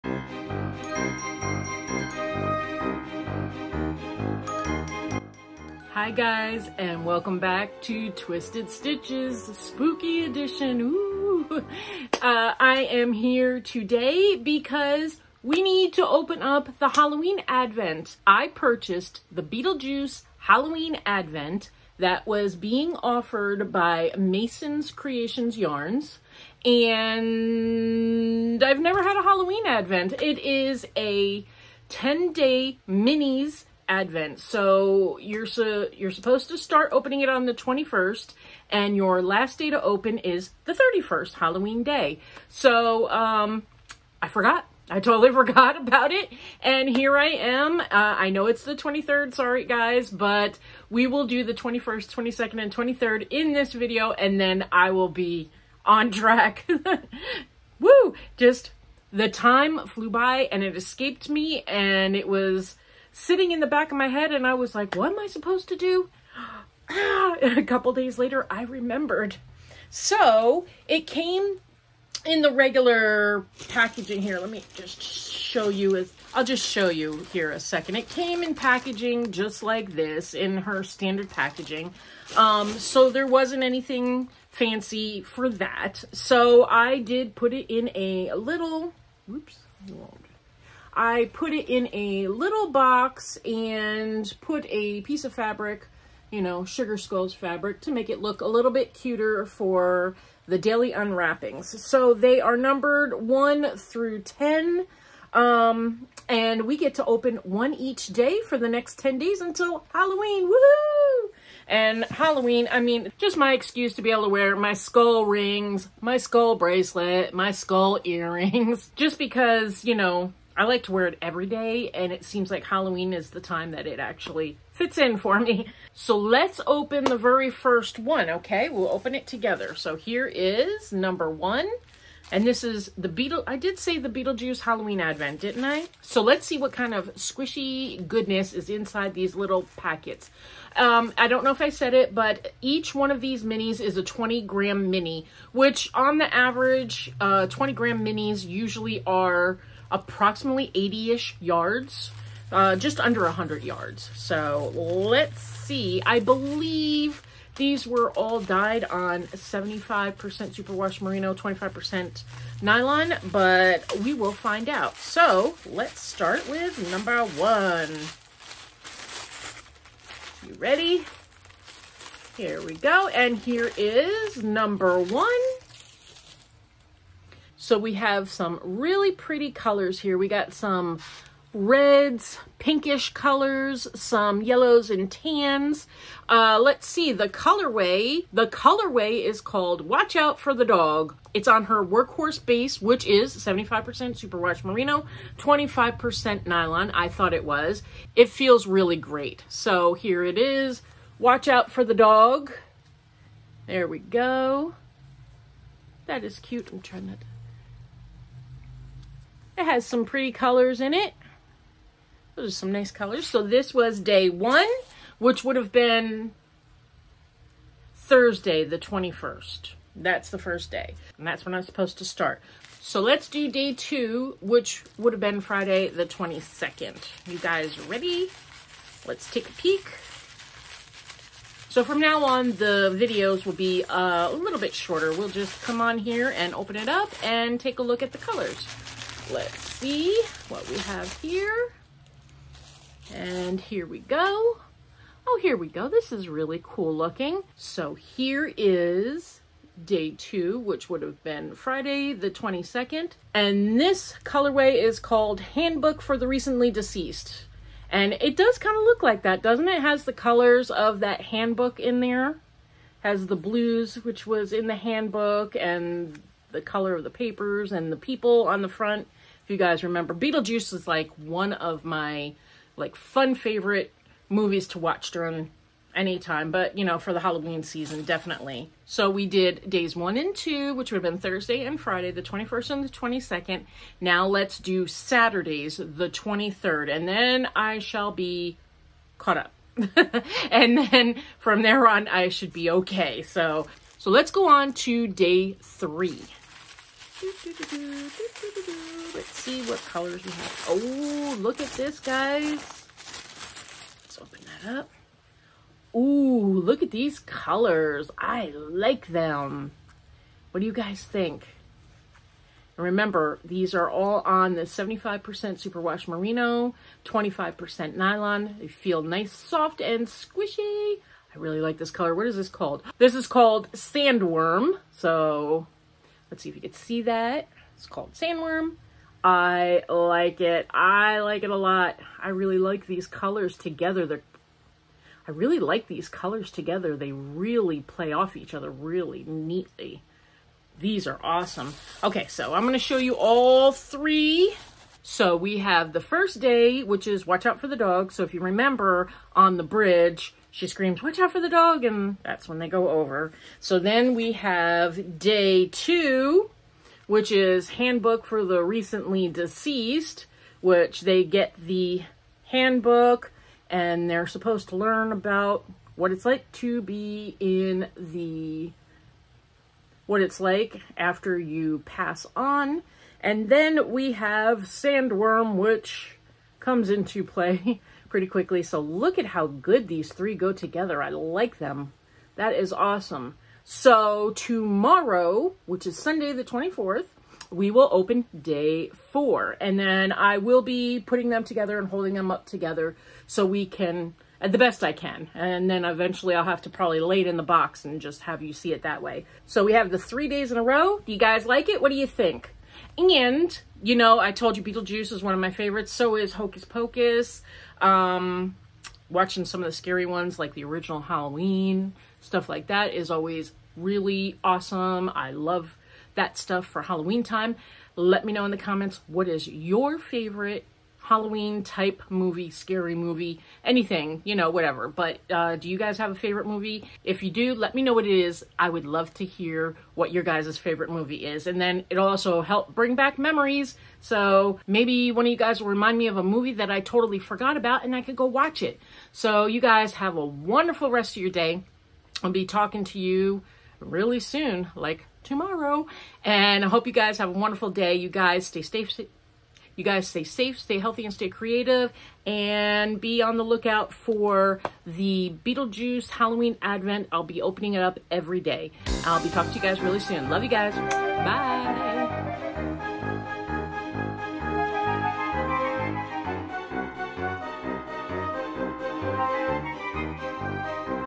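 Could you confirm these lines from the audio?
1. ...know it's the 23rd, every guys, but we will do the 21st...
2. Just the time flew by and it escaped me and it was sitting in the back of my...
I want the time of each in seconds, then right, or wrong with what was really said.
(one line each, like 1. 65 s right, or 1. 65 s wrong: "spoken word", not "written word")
1. 48 s wrong: "sorry", not "every"
2. 58 s right.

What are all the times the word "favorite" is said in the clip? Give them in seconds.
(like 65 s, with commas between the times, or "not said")
273 s, 405 s, 419 s, 426 s, 430 s.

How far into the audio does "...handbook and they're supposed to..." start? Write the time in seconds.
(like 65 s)
362 s.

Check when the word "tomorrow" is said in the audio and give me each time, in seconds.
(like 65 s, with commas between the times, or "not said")
384 s, 445 s.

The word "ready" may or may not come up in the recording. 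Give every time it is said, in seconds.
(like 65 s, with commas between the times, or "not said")
170 s, 227 s.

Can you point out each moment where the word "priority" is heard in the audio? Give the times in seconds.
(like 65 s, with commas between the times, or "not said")
not said.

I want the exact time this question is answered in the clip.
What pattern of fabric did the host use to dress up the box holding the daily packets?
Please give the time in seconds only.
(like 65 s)
96 s.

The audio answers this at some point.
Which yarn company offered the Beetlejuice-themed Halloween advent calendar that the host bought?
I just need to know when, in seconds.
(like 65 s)
24 s.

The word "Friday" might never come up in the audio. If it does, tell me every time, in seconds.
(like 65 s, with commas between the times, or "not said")
225 s, 251 s, 281 s.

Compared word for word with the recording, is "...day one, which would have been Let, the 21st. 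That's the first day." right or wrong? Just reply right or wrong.
wrong.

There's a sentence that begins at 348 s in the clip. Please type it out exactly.
So if you remember on the bridge, she screams, watch out for the dog, and that's when they go over.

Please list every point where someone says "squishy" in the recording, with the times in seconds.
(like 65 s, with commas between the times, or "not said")
137 s, 320 s.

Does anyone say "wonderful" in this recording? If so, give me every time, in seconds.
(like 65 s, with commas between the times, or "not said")
440 s, 447 s.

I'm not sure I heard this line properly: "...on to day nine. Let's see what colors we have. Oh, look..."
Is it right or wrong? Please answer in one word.
wrong.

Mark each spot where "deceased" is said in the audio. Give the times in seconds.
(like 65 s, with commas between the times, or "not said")
256 s, 359 s.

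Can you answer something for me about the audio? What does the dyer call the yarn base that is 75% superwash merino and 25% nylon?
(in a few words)
workhorse.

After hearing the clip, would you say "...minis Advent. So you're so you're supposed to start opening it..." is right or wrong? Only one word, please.
right.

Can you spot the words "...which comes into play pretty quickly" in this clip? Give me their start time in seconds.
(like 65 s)
375 s.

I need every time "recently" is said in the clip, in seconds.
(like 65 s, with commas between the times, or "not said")
256 s, 358 s.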